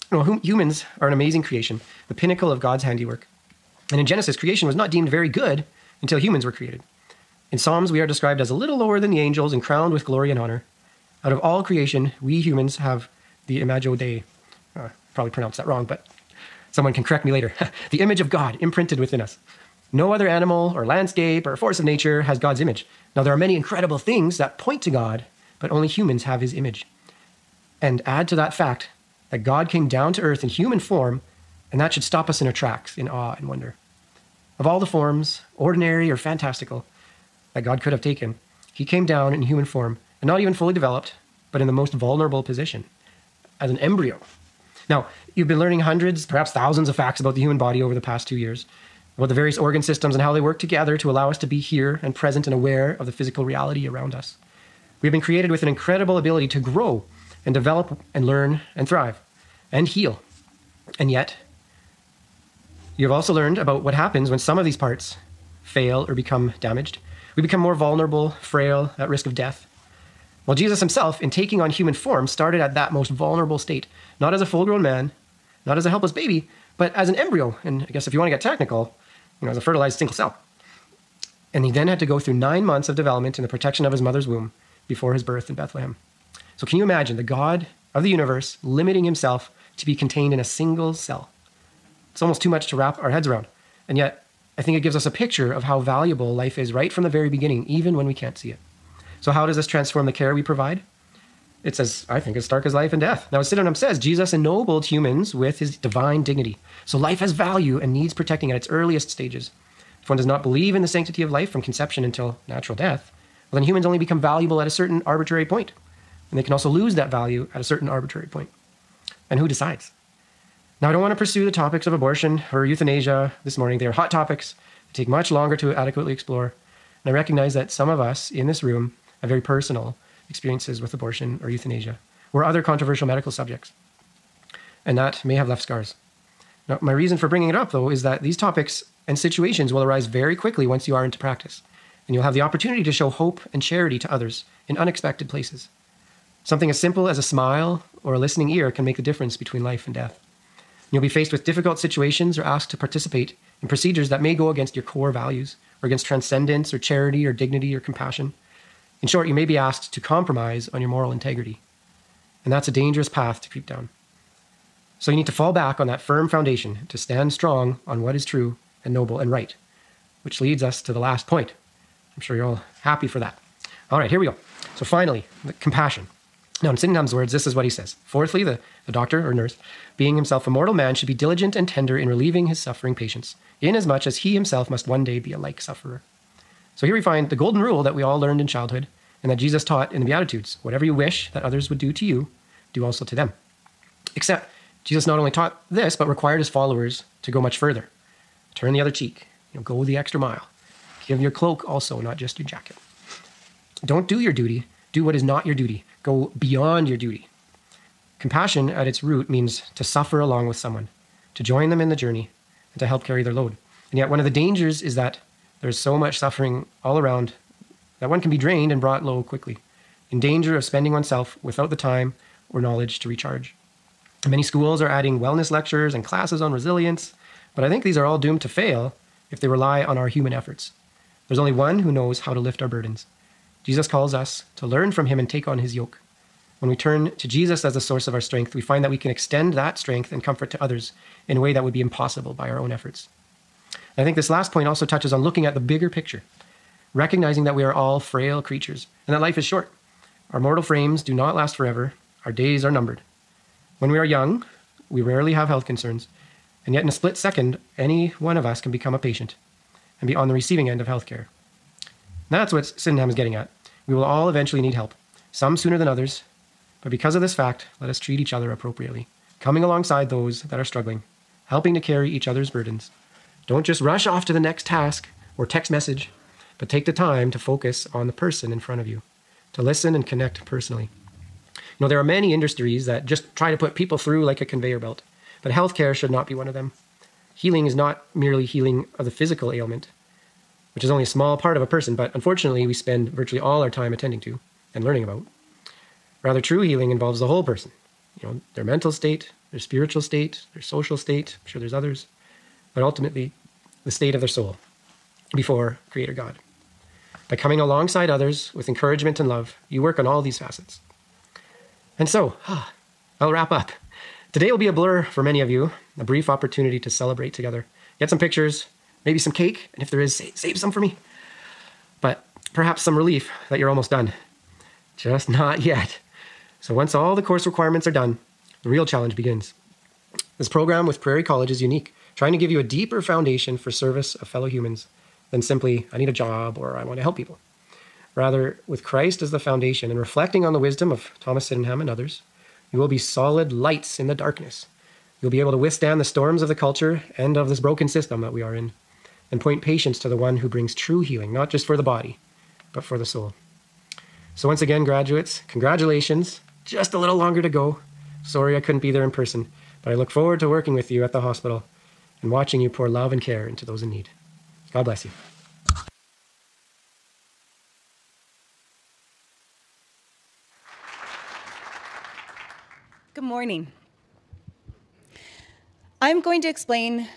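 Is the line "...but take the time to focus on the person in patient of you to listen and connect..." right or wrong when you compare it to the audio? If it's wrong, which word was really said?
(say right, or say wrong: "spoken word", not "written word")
wrong: "front", not "patient".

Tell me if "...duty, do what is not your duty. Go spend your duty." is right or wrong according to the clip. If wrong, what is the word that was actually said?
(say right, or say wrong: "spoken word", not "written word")
wrong: "beyond", not "spend".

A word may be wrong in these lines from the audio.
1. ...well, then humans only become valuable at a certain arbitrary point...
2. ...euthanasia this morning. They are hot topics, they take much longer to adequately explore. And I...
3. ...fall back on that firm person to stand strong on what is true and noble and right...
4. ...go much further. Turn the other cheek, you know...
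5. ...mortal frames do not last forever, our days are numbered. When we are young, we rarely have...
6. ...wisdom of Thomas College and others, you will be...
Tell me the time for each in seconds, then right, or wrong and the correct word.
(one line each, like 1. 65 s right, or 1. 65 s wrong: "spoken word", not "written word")
1. 113 s right
2. 122 s right
3. 165 s wrong: "foundation", not "person"
4. 197 s right
5. 250 s right
6. 340 s wrong: "Sydenham", not "College".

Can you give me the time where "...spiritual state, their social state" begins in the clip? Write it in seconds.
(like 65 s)
299 s.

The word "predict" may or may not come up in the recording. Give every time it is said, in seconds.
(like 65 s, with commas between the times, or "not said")
not said.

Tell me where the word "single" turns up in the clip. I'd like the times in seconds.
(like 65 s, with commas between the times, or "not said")
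79 s, 90 s.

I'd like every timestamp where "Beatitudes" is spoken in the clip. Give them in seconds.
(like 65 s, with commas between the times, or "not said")
190 s.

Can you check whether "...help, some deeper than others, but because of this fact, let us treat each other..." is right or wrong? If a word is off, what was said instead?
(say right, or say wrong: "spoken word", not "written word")
wrong: "sooner", not "deeper".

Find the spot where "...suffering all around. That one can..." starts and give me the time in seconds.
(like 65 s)
216 s.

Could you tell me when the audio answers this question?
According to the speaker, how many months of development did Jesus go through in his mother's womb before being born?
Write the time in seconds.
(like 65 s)
82 s.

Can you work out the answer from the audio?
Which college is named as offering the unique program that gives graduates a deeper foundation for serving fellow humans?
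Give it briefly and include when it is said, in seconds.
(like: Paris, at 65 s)
Prairie College, at 330 s.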